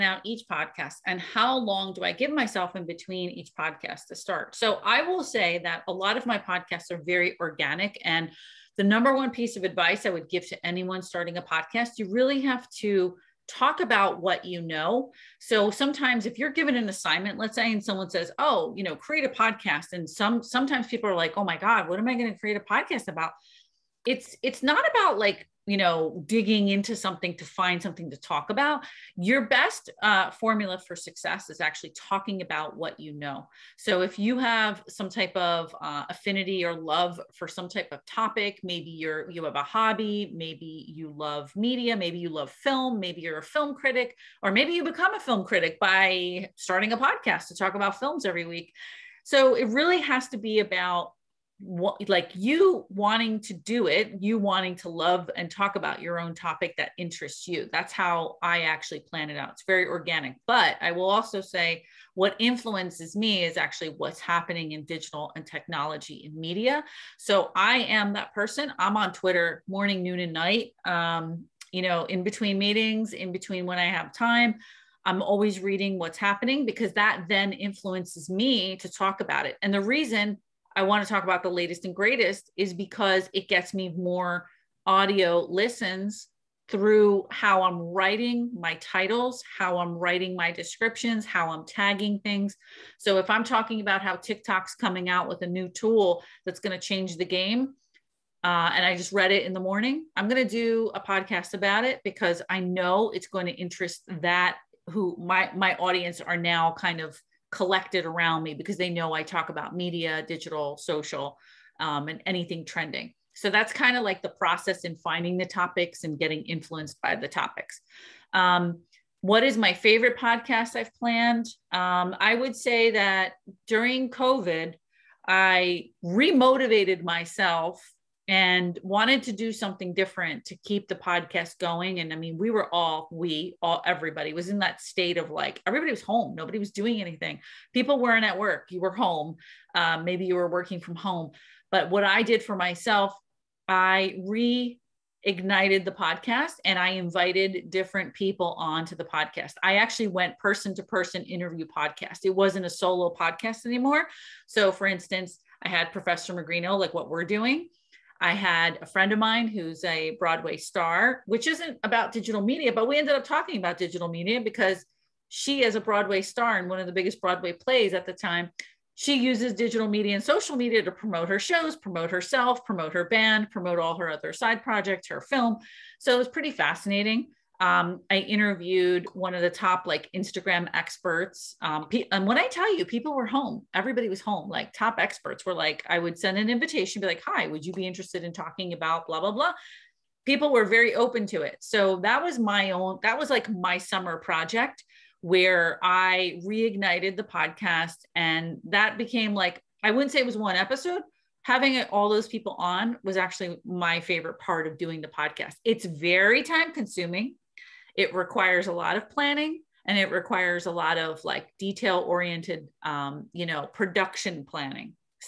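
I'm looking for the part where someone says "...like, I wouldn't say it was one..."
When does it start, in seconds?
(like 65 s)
199 s.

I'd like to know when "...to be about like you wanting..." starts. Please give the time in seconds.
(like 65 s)
50 s.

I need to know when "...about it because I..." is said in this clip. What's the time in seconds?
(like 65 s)
101 s.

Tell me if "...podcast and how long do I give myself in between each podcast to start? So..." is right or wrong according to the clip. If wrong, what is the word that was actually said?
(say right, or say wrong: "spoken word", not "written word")
right.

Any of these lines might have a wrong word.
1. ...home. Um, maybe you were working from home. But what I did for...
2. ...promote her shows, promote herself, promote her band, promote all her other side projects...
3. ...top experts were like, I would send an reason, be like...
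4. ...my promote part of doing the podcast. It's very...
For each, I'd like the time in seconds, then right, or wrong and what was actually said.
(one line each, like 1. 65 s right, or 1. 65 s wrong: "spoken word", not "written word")
1. 138 s right
2. 170 s right
3. 184 s wrong: "invitation", not "reason"
4. 203 s wrong: "favorite", not "promote".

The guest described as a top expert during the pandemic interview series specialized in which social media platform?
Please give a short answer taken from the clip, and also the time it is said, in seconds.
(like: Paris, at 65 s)
Instagram, at 180 s.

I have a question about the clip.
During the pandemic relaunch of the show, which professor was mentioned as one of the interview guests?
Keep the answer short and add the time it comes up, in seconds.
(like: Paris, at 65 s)
Professor Magrino, at 155 s.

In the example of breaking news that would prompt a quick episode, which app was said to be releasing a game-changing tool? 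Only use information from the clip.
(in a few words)
TikTok.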